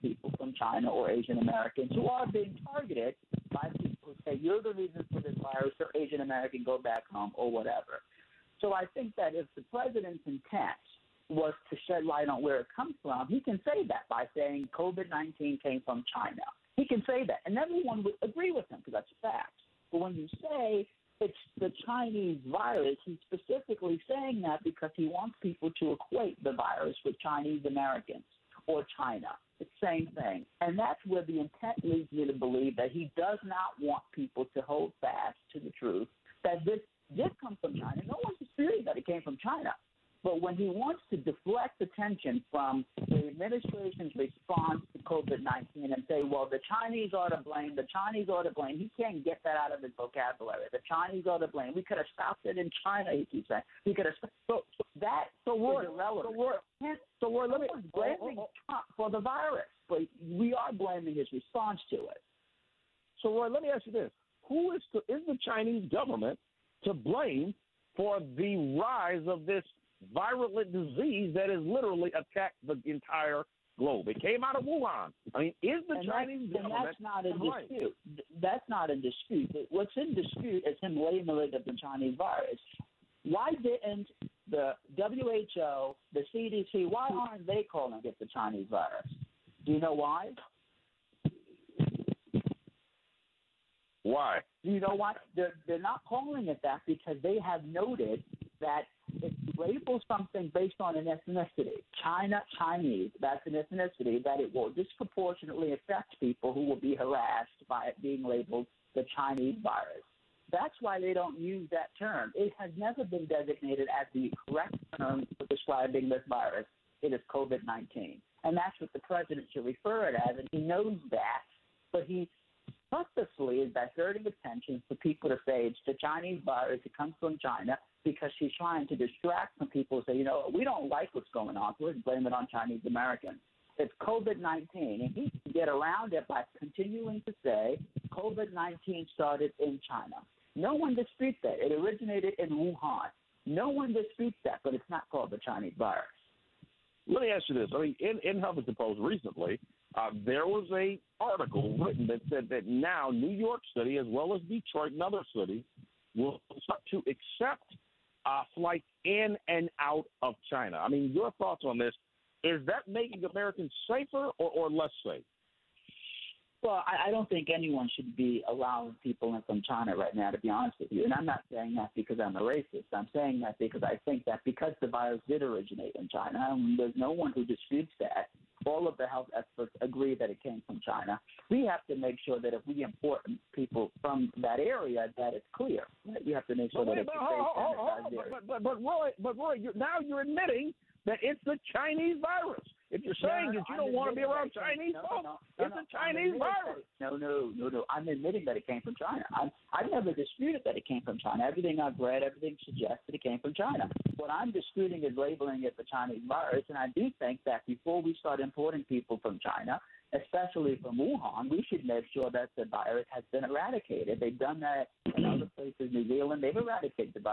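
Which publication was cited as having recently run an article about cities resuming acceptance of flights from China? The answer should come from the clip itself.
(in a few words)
Huffington Post.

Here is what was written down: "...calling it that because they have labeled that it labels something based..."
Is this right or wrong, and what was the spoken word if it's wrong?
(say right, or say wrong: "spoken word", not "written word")
wrong: "noted", not "labeled".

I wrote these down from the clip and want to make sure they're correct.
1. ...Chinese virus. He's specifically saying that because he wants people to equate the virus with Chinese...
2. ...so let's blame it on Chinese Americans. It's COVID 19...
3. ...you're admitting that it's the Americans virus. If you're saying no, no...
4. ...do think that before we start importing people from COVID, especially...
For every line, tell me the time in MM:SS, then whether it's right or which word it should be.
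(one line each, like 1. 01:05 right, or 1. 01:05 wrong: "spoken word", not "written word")
1. 00:21 right
2. 02:11 right
3. 03:10 wrong: "Chinese", not "Americans"
4. 03:26 wrong: "China", not "COVID".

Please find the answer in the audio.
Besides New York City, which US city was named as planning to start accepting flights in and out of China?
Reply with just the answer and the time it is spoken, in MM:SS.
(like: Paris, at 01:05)
Detroit, at 02:34.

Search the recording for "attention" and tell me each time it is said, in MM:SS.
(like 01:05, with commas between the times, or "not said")
00:41, 02:04.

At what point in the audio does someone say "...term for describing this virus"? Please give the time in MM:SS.
01:54.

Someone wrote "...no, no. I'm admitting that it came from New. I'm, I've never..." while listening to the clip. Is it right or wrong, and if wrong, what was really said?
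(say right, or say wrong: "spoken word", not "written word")
wrong: "China", not "New".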